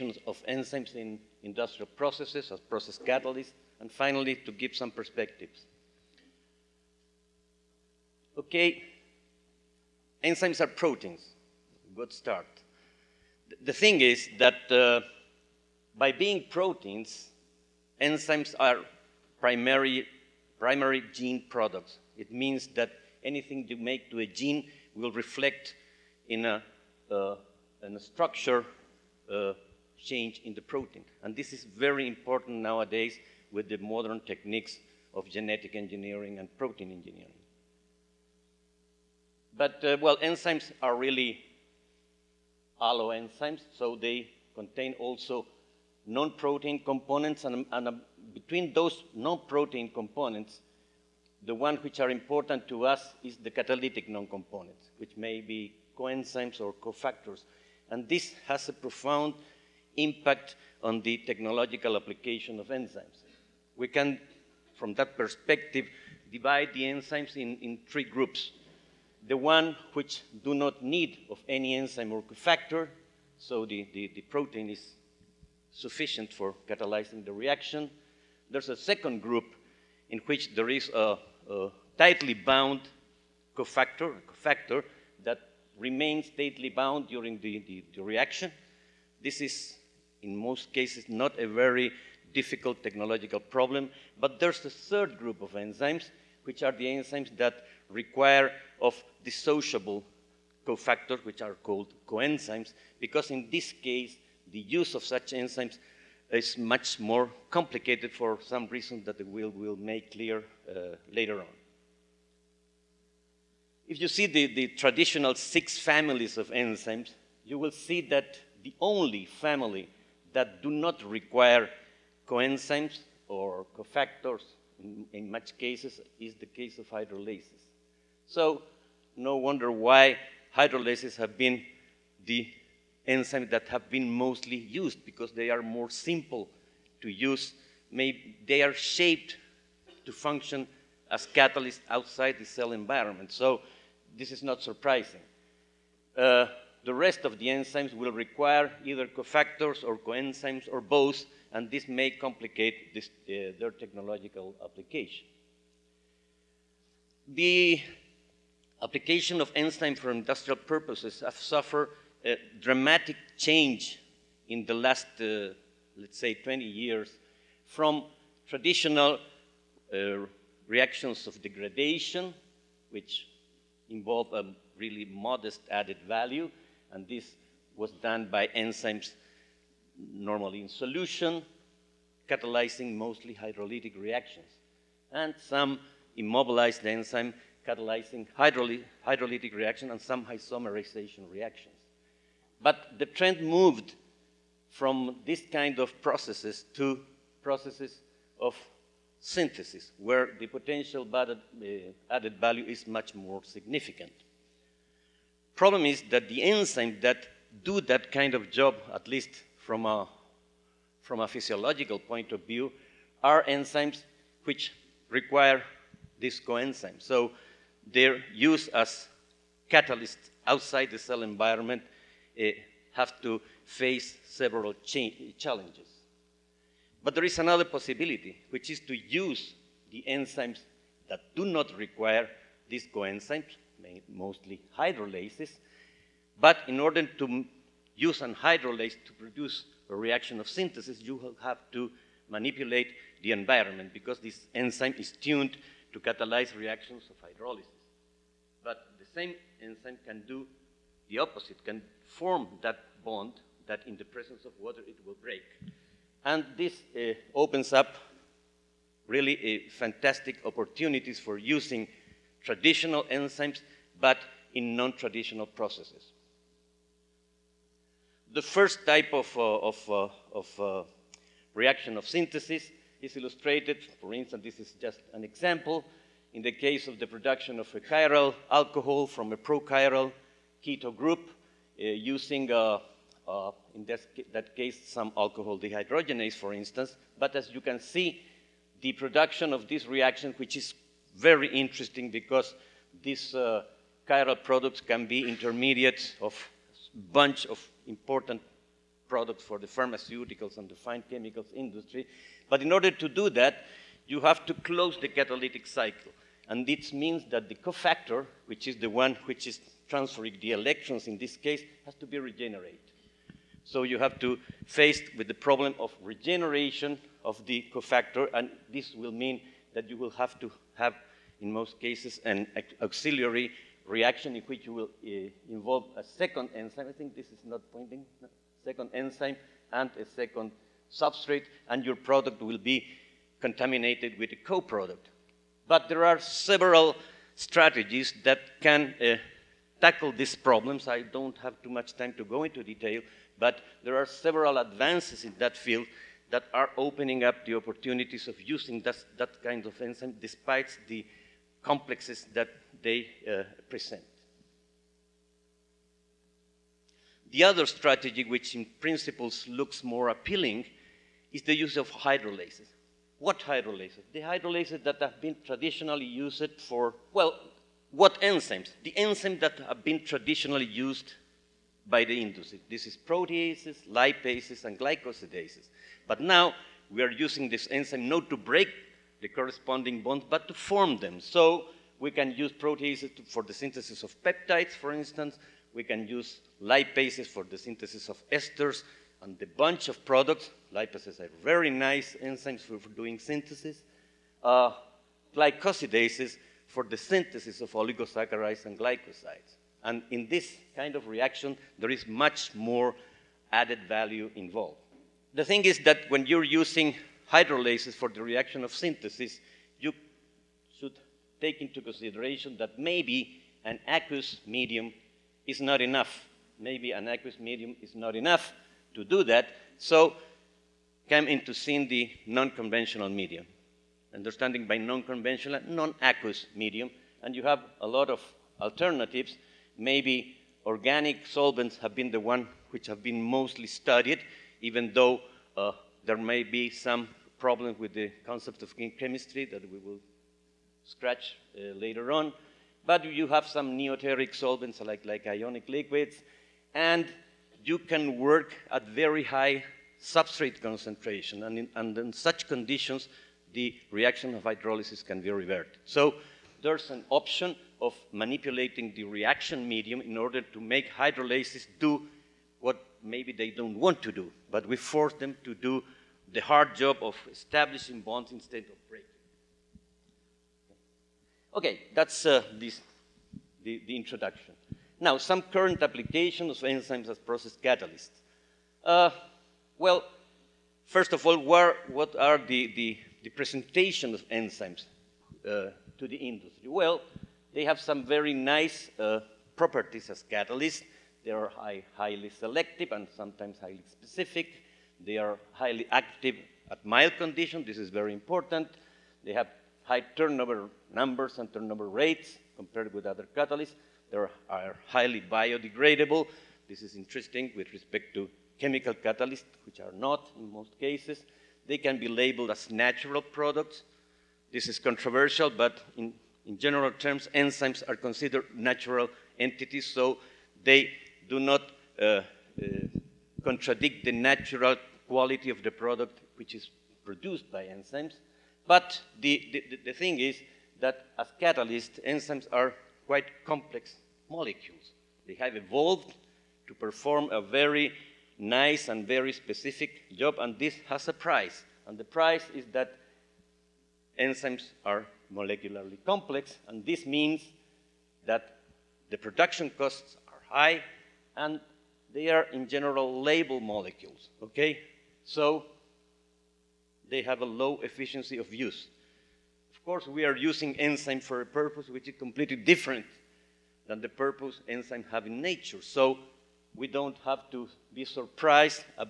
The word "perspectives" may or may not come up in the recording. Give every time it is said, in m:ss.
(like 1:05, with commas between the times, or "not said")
0:04, 1:05.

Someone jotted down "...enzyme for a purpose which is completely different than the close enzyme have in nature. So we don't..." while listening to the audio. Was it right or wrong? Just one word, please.
wrong.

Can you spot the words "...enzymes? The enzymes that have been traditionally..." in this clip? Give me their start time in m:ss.
6:08.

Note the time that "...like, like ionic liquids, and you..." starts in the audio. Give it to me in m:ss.
7:24.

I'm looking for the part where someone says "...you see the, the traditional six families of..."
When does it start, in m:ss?
1:54.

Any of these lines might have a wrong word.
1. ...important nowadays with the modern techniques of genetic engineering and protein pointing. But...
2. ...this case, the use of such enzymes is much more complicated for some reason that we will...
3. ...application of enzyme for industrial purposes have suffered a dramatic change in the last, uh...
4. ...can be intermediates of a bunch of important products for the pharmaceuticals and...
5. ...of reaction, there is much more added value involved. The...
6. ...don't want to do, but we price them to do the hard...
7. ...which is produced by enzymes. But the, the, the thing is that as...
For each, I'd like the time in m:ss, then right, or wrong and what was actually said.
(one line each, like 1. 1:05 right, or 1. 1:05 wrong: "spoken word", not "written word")
1. 0:32 wrong: "engineering", not "pointing"
2. 1:43 right
3. 2:38 right
4. 4:54 right
5. 6:40 right
6. 7:43 wrong: "force", not "price"
7. 8:46 right.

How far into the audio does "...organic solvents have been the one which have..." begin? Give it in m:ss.
7:10.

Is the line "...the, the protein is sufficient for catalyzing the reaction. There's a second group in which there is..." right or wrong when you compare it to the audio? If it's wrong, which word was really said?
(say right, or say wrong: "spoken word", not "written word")
right.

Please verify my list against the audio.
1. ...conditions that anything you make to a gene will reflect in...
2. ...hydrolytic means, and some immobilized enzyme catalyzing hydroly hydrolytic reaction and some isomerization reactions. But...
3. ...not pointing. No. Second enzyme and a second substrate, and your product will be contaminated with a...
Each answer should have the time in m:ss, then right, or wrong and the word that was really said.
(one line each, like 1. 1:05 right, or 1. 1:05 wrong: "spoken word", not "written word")
1. 0:22 wrong: "means", not "conditions"
2. 3:03 wrong: "reactions", not "means"
3. 5:27 right.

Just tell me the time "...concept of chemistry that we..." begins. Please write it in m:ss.
7:18.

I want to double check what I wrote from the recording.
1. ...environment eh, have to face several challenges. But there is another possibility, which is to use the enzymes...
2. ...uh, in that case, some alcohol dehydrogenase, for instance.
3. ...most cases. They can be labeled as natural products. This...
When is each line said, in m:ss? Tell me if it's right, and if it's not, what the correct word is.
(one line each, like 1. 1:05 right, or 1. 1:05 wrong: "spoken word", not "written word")
1. 3:41 right
2. 4:43 right
3. 8:30 right.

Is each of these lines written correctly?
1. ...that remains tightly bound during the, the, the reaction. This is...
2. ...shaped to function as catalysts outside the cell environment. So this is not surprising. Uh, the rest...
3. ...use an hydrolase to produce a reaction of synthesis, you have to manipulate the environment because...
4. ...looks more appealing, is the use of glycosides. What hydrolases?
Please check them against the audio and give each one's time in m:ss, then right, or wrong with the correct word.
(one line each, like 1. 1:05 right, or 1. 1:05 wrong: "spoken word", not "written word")
1. 1:25 right
2. 2:18 right
3. 3:57 right
4. 5:59 wrong: "hydrolases", not "glycosides".